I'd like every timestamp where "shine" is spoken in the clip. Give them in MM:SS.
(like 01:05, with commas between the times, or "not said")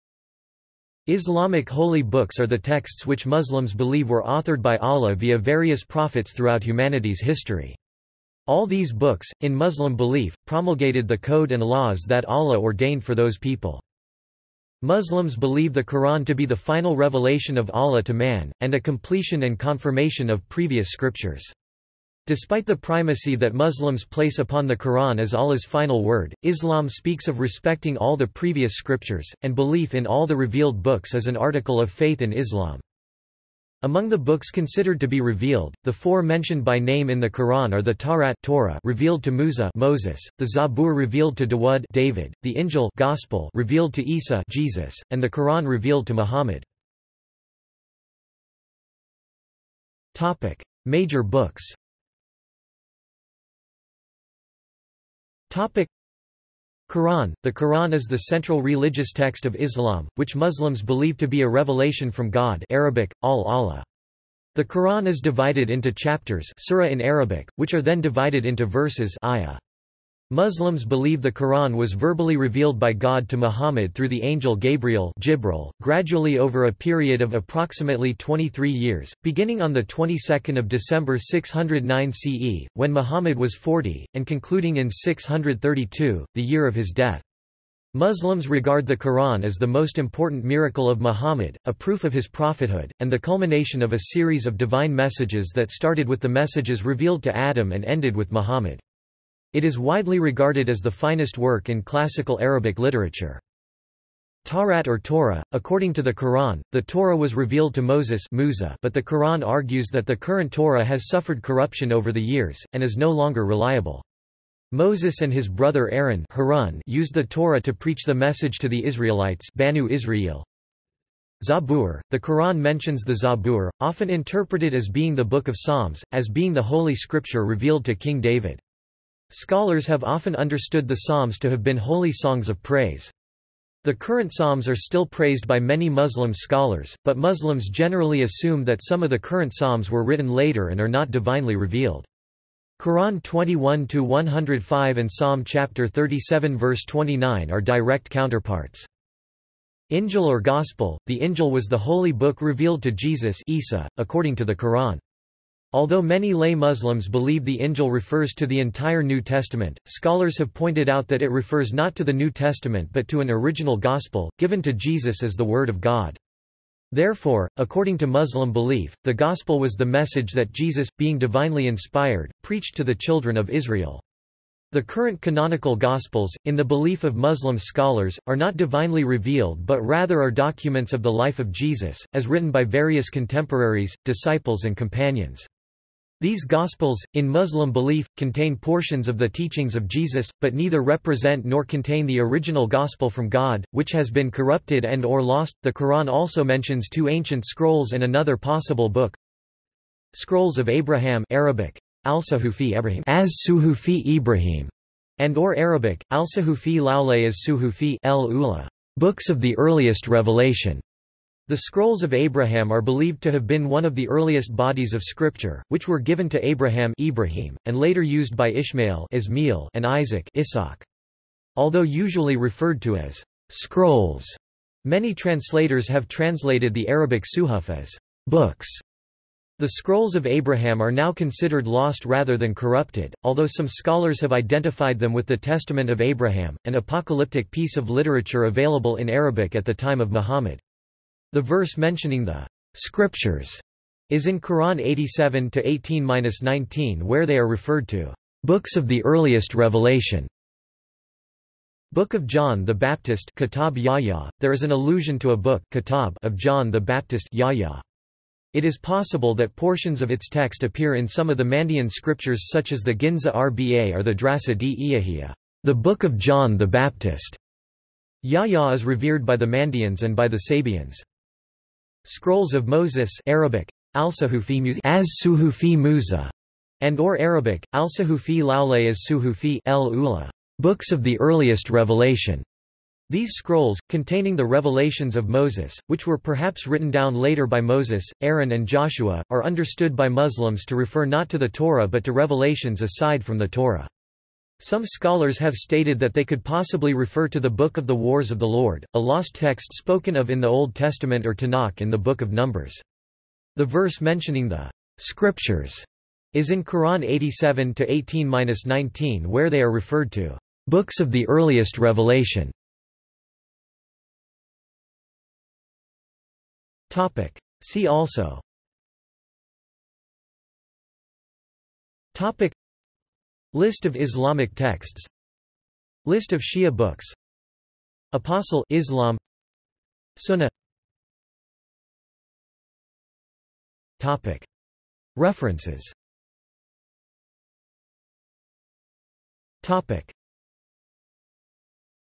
not said.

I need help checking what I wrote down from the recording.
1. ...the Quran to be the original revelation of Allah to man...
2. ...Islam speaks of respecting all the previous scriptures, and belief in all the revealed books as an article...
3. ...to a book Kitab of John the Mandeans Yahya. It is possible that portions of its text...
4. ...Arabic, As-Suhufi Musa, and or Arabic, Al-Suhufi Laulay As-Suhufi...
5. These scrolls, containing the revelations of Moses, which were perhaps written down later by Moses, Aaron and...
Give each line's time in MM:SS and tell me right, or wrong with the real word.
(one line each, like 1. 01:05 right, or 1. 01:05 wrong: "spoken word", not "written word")
1. 00:15 wrong: "final", not "original"
2. 00:26 right
3. 04:15 wrong: "Baptist", not "Mandeans"
4. 04:33 right
5. 04:43 right.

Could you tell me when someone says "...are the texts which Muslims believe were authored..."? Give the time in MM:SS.
00:02.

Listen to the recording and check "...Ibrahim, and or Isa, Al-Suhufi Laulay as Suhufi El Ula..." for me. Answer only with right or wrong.
wrong.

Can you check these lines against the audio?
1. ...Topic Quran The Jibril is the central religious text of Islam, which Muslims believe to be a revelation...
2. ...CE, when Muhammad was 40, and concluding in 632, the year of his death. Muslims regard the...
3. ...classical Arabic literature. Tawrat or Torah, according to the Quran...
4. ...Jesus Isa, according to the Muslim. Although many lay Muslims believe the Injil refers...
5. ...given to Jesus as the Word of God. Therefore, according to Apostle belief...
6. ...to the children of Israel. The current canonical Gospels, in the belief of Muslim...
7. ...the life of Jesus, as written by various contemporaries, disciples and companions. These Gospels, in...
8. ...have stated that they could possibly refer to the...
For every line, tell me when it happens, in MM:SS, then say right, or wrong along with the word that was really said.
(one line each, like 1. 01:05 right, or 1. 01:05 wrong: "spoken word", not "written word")
1. 00:55 wrong: "Quran", not "Jibril"
2. 01:22 right
3. 01:41 right
4. 02:32 wrong: "Quran", not "Muslim"
5. 02:44 wrong: "Muslim", not "Apostle"
6. 02:52 right
7. 03:01 right
8. 04:55 right.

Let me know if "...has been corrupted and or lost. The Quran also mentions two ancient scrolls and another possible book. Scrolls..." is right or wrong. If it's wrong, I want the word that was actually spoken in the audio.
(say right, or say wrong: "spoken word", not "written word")
right.